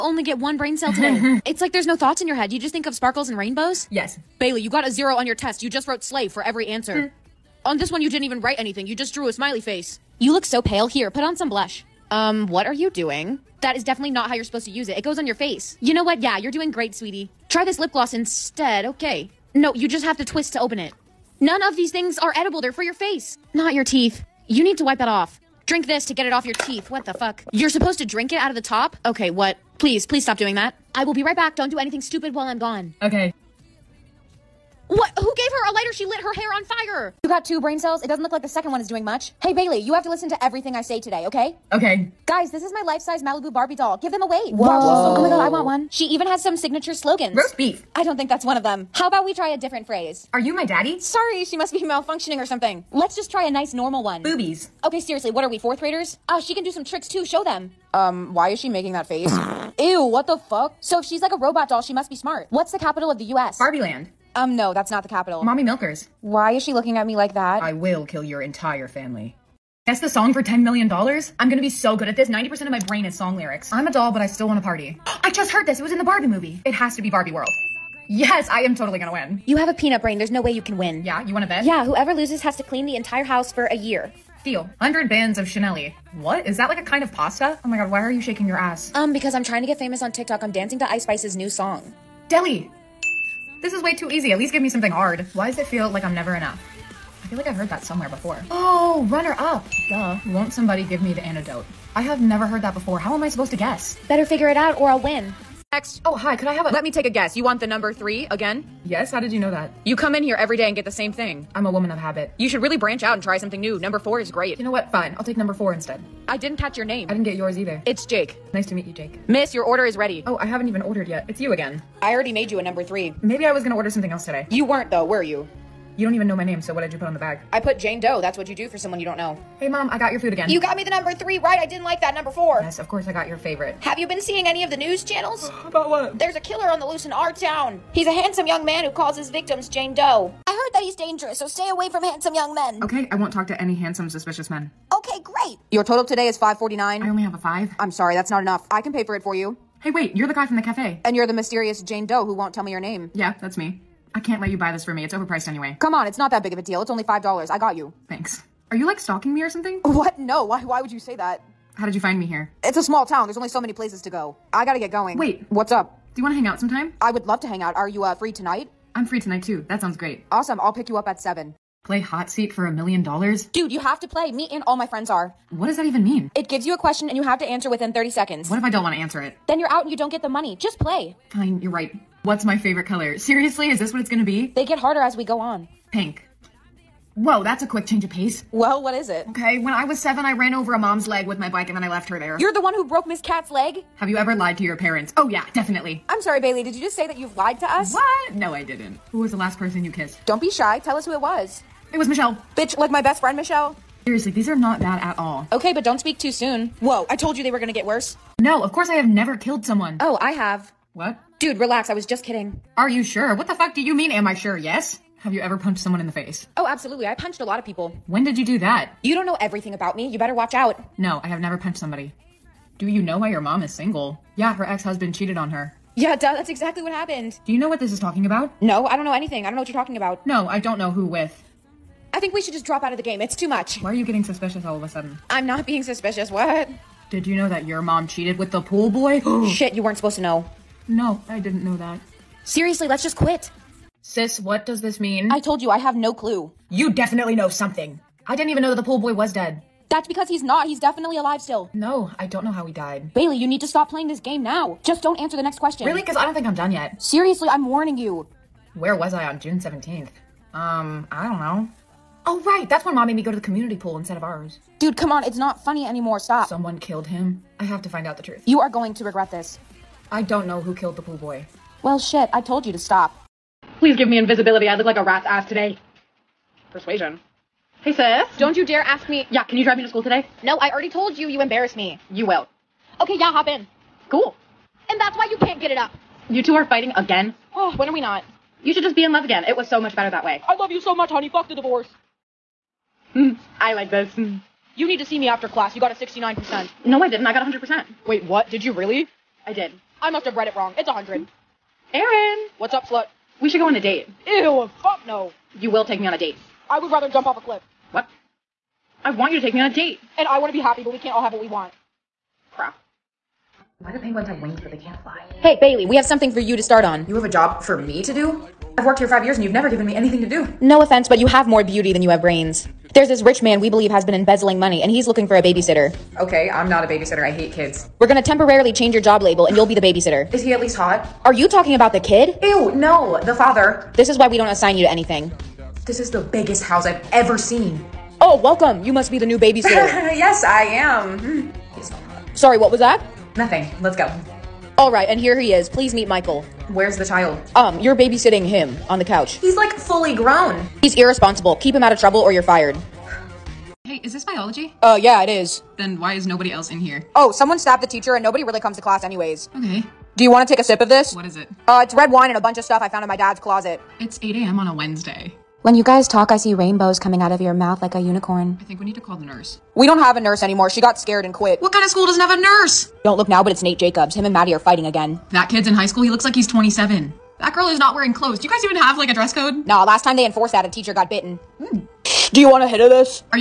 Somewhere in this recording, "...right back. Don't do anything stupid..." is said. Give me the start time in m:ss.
0:31.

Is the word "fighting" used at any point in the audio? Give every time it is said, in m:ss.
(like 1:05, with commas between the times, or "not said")
4:46, 6:14.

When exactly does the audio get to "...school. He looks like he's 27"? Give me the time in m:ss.
6:15.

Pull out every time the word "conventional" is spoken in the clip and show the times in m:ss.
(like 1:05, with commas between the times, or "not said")
not said.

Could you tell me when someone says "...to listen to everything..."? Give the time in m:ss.
0:40.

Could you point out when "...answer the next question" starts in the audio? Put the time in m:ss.
4:15.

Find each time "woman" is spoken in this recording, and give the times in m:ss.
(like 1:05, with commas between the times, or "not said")
1:51.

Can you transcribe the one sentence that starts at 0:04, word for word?
Bailey, you got a zero on your test.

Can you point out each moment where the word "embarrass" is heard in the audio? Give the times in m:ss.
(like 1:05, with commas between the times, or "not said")
4:41.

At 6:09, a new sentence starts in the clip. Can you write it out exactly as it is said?
We don't have a nurse anymore.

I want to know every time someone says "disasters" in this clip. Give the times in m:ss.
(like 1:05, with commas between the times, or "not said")
not said.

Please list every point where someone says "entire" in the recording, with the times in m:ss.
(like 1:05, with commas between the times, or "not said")
1:08, 1:22.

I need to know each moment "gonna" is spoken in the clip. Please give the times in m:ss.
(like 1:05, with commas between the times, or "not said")
1:11, 1:18, 2:03, 3:04, 3:27, 5:28.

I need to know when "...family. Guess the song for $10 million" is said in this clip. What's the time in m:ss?
1:08.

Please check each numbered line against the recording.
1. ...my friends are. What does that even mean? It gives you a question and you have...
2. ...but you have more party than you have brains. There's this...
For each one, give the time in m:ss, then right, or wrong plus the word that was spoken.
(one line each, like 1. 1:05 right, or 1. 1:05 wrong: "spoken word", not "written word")
1. 2:54 right
2. 5:21 wrong: "beauty", not "party".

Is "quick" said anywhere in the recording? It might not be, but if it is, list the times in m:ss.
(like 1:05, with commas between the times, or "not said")
3:07.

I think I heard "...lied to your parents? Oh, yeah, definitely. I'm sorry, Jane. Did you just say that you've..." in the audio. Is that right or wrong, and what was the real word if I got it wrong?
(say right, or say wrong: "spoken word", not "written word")
wrong: "Bailey", not "Jane".